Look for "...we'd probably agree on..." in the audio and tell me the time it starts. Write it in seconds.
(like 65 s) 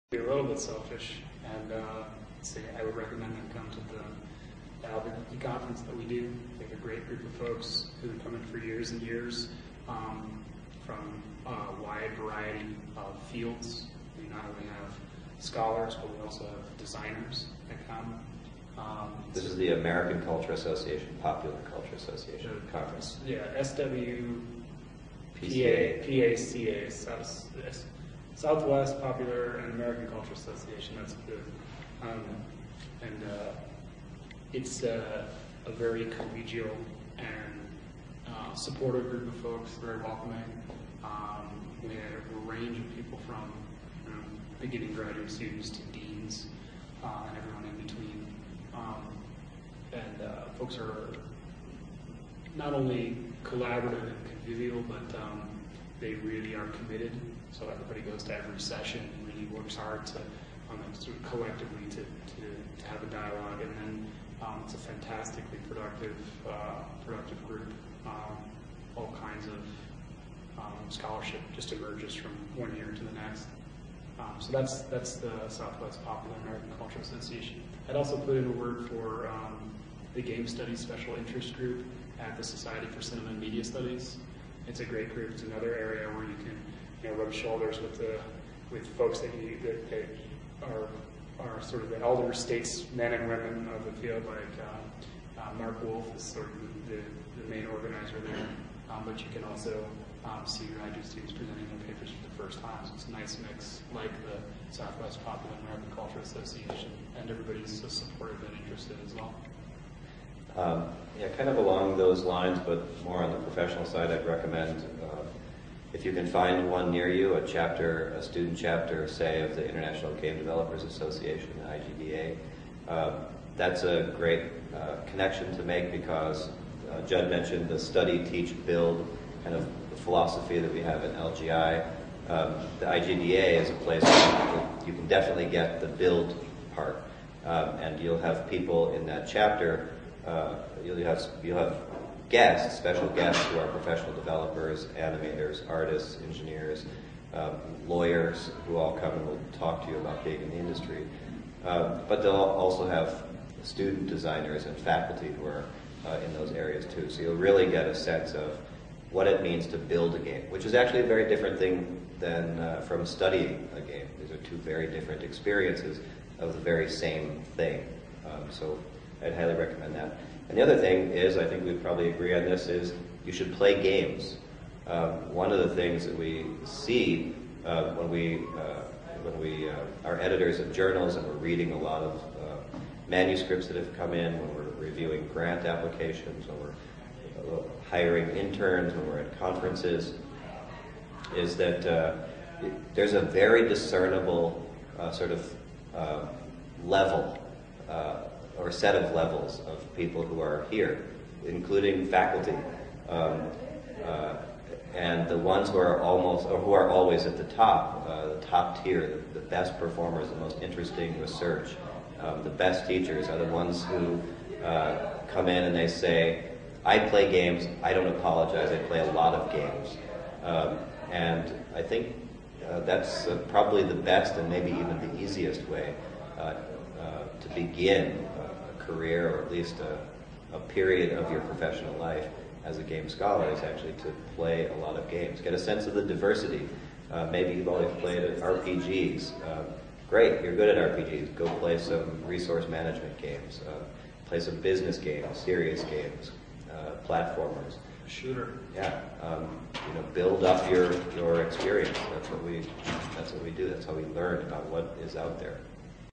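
171 s.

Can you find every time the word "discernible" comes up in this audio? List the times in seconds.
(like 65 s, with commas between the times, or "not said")
193 s.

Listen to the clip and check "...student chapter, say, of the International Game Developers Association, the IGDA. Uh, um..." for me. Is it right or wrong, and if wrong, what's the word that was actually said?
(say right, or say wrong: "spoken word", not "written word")
right.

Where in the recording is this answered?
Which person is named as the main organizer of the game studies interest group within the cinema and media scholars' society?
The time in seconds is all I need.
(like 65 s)
95 s.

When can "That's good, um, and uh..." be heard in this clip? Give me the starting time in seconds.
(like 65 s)
30 s.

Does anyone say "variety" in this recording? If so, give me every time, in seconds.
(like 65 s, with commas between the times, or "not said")
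12 s.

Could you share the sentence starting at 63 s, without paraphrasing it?
And then um, it's a fantastically productive, uh, productive group.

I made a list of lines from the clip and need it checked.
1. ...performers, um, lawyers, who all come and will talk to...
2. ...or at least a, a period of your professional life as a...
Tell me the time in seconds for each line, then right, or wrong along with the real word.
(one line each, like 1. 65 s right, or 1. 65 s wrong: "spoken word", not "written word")
1. 146 s wrong: "engineers", not "performers"
2. 229 s right.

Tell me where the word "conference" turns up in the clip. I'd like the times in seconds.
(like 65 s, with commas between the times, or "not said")
5 s, 22 s, 189 s.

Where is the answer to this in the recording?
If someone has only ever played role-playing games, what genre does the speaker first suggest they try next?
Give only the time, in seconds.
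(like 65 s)
242 s.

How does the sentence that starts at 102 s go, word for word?
So it's a nice mix, like the Southwest Popular American Culture Association, and everybody's so supportive and interested as well.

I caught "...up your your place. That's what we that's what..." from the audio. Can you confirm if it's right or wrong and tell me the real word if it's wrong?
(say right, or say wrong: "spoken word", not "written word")
wrong: "experience", not "place".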